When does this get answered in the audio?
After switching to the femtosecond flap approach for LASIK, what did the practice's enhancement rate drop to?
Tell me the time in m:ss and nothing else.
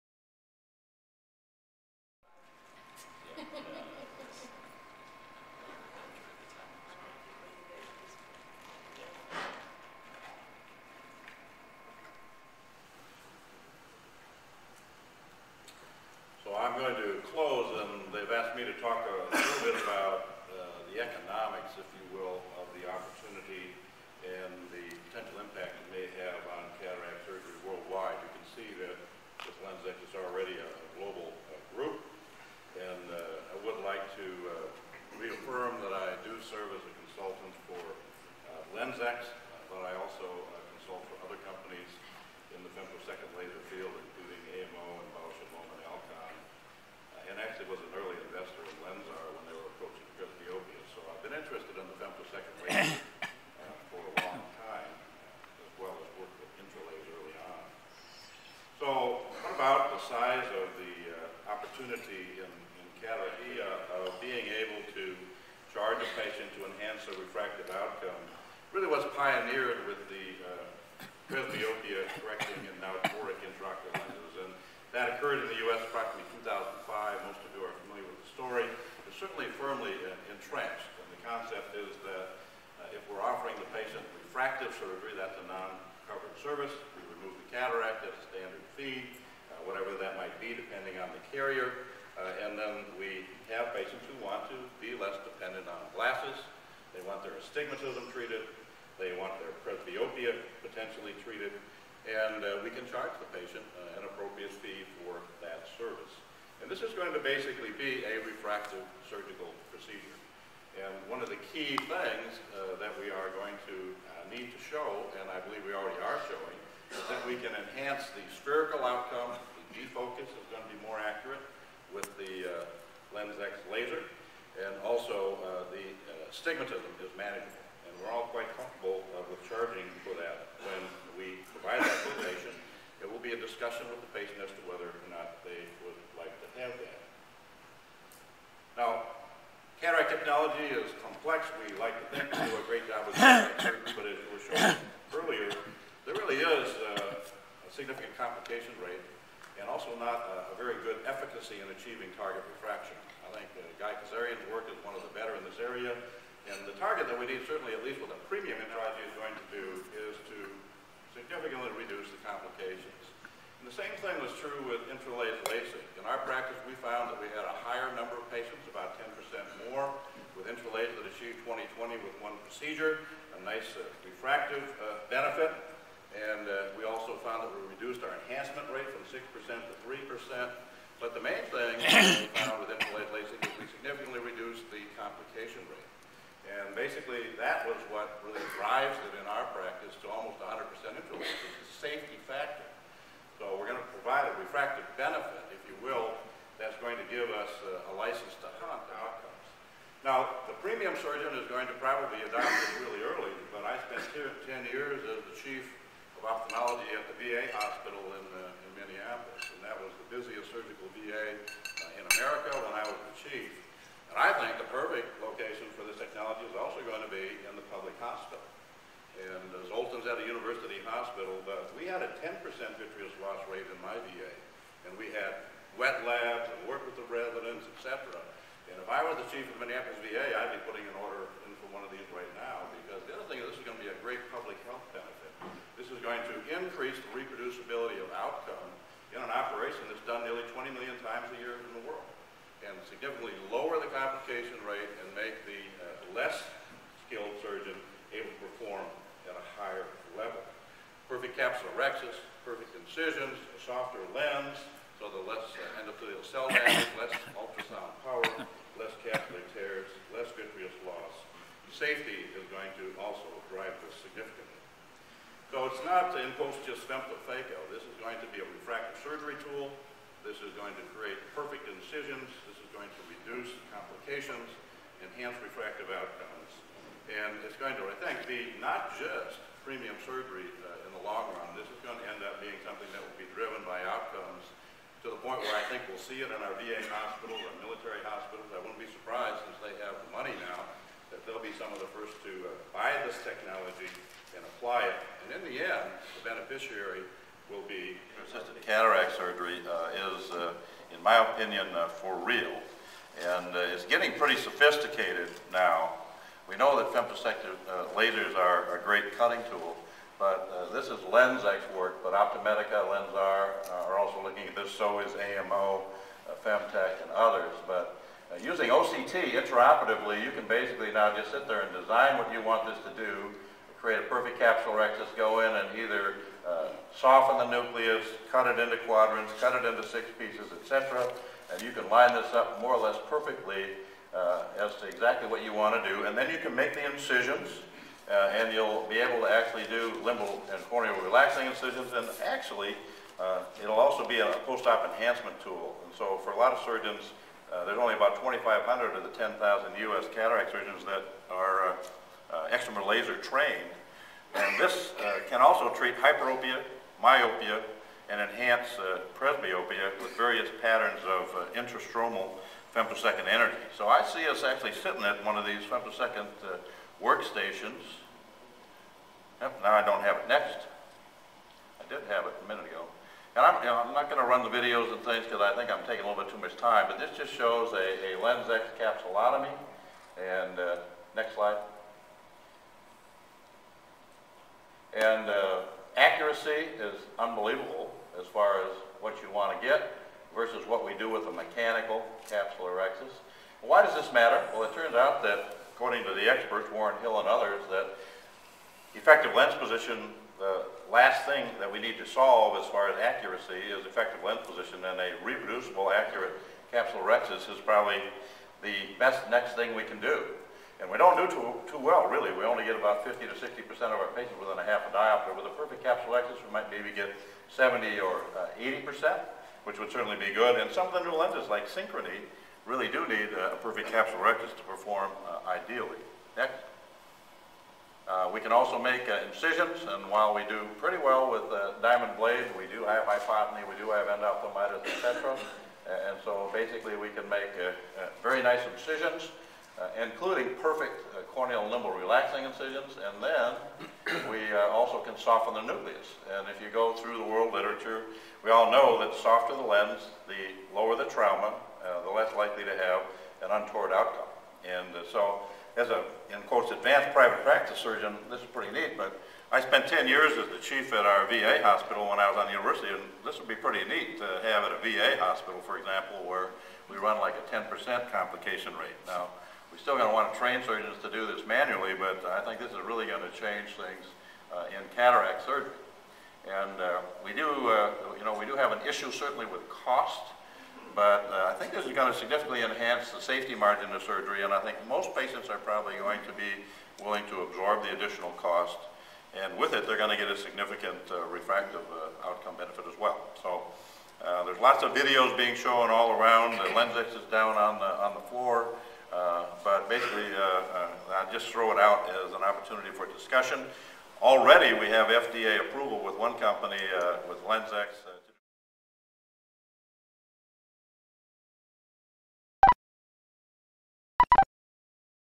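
2:59.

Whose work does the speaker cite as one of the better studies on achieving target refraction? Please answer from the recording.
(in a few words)
Guy Kezirian.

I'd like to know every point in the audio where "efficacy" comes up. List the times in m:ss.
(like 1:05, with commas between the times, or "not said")
2:31.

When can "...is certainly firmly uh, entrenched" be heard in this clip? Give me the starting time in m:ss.
1:19.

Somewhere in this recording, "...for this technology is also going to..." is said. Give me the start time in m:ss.
3:35.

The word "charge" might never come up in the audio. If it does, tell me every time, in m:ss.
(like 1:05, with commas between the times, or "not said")
1:05, 1:42.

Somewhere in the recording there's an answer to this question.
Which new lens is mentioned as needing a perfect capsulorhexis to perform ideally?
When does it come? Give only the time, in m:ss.
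7:01.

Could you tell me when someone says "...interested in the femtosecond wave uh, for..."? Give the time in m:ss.
0:51.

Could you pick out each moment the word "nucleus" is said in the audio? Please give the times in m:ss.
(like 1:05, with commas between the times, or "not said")
5:27, 7:25.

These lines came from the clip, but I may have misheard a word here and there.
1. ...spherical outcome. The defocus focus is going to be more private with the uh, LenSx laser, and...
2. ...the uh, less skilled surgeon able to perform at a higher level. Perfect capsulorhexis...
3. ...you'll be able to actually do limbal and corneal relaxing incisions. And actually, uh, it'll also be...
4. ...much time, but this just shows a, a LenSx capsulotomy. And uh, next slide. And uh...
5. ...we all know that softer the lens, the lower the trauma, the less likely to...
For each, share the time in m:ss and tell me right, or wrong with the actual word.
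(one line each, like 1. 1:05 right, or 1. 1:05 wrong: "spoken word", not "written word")
1. 1:58 wrong: "accurate", not "private"
2. 4:05 right
3. 5:38 right
4. 6:16 right
5. 7:28 right.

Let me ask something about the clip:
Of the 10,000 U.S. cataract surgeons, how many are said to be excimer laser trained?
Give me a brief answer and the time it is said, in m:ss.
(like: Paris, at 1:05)
2,500, at 5:48.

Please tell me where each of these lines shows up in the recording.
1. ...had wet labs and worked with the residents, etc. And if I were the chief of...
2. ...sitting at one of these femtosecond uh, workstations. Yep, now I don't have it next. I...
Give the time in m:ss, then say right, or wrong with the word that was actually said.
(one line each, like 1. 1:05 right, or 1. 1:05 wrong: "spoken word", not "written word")
1. 3:45 right
2. 6:04 right.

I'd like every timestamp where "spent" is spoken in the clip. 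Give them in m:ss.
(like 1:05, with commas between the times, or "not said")
3:23, 7:39.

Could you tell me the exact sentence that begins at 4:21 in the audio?
Safety is going to also drive this significantly.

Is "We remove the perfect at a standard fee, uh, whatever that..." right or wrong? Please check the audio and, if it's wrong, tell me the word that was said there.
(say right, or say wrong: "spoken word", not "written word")
wrong: "cataract", not "perfect".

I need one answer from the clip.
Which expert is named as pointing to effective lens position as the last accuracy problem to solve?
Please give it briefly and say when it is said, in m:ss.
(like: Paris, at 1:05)
Warren Hill, at 6:36.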